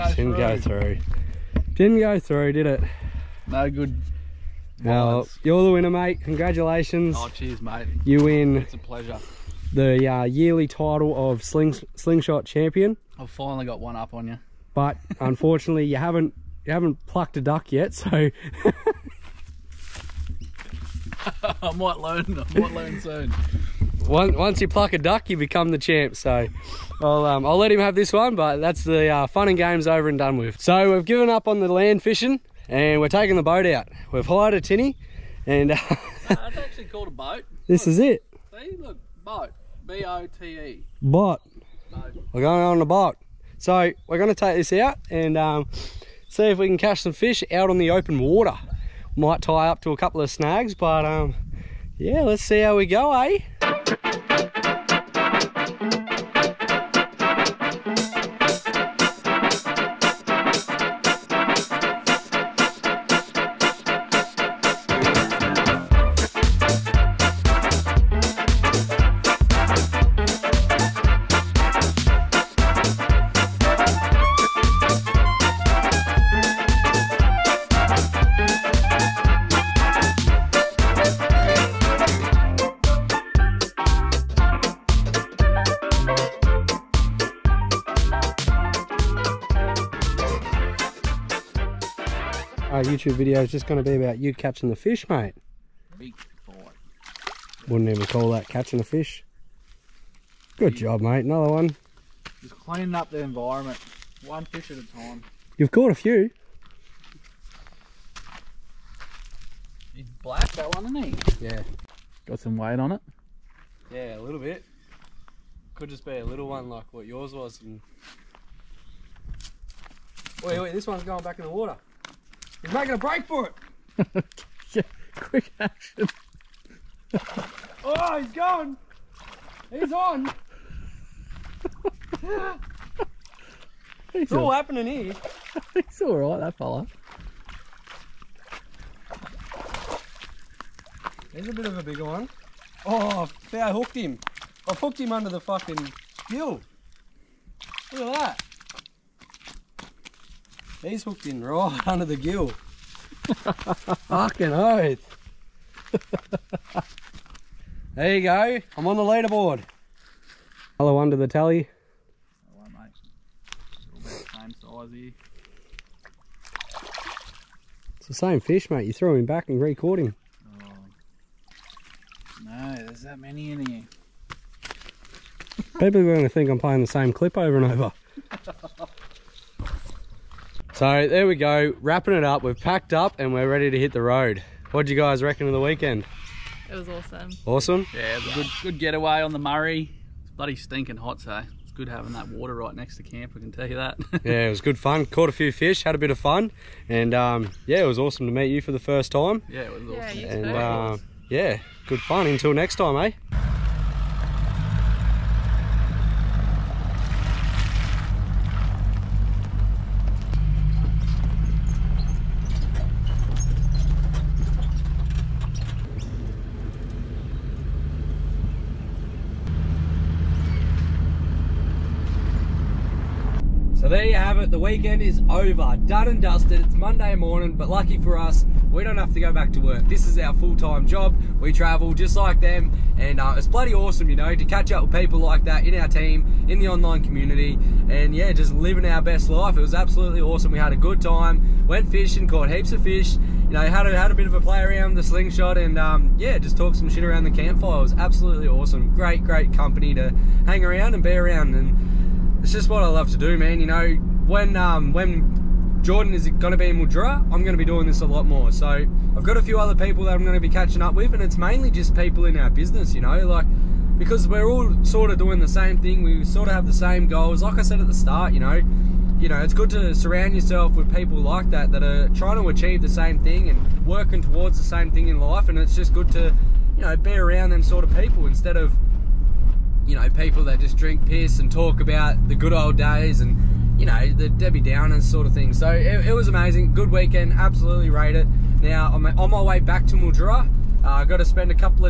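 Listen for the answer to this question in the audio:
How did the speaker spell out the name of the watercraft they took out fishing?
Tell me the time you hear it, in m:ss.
0:39.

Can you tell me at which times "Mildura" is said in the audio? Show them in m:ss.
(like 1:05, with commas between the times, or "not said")
4:16, 4:49.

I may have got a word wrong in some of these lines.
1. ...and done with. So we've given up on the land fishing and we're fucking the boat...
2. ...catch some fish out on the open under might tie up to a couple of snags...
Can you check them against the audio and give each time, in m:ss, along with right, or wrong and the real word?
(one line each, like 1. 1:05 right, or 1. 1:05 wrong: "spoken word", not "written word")
1. 0:30 wrong: "taking", not "fucking"
2. 0:46 wrong: "water", not "under".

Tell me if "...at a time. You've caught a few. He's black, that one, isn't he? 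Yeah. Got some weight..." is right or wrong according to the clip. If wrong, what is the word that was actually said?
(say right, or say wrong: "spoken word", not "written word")
right.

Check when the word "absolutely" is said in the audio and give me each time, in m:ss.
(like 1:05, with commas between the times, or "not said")
3:59, 4:07, 4:47.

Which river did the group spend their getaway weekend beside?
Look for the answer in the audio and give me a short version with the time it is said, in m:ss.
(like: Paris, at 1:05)
Murray, at 3:09.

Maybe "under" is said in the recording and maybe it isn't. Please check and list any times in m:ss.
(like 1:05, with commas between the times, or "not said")
2:25, 2:31, 2:40.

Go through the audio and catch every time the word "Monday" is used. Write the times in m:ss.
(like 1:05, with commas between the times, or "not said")
3:46.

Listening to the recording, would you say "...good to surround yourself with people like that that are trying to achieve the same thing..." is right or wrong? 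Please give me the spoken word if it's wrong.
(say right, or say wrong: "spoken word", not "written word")
right.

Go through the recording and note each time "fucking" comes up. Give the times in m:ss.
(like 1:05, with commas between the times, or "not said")
2:25, 2:34.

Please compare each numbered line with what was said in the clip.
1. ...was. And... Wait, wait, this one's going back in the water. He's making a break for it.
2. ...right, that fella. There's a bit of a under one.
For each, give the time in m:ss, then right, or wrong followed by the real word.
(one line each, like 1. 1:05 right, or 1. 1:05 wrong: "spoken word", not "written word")
1. 1:57 right
2. 2:16 wrong: "bigger", not "under".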